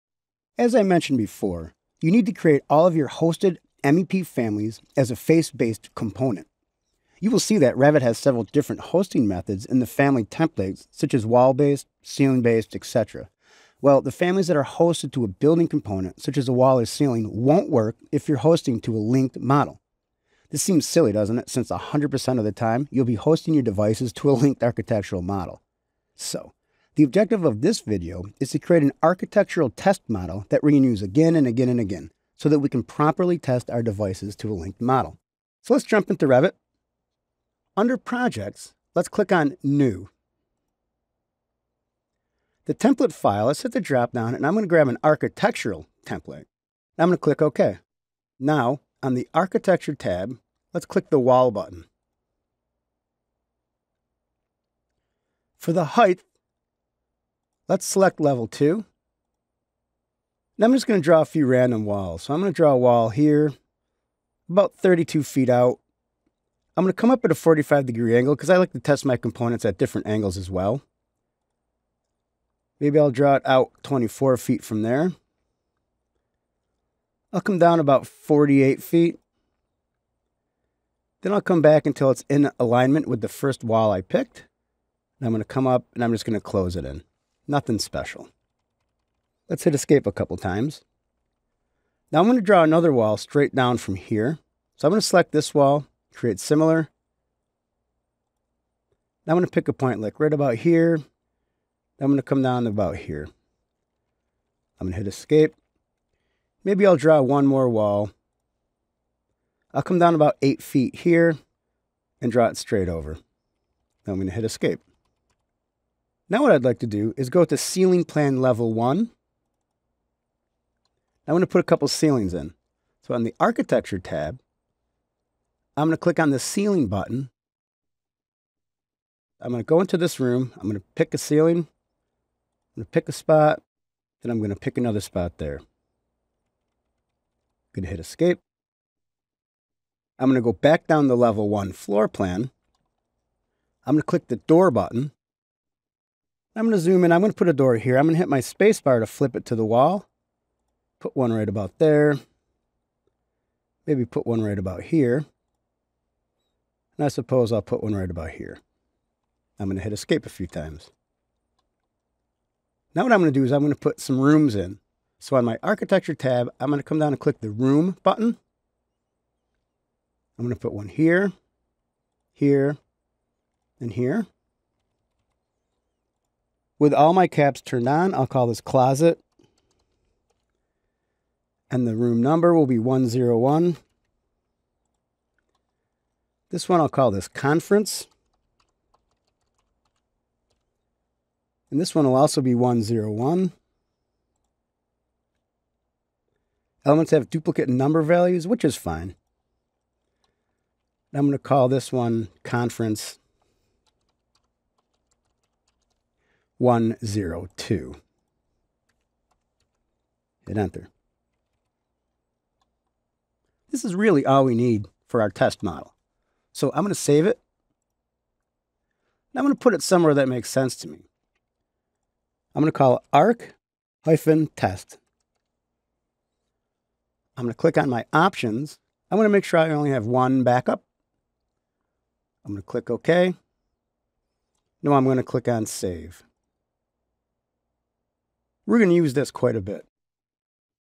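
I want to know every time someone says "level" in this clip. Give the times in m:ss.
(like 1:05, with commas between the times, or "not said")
0:58, 1:58, 2:21.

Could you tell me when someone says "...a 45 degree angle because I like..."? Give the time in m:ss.
1:07.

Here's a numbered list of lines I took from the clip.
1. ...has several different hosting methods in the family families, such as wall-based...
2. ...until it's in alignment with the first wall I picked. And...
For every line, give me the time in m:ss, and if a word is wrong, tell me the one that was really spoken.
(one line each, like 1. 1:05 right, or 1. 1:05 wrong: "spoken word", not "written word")
1. 0:08 wrong: "templates", not "families"
2. 1:21 right.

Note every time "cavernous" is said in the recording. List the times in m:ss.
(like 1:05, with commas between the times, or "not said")
not said.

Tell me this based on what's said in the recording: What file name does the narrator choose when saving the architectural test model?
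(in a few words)
arc-test.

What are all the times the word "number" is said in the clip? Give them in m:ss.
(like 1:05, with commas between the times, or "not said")
3:02, 3:17.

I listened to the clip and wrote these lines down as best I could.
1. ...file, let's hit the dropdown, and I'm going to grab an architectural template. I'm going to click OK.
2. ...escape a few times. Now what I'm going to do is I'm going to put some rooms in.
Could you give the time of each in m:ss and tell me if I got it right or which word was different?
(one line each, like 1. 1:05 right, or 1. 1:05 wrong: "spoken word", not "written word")
1. 0:43 right
2. 2:39 right.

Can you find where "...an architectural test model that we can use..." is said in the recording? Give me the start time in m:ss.
0:28.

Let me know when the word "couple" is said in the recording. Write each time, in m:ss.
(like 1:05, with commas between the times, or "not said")
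1:30, 2:01.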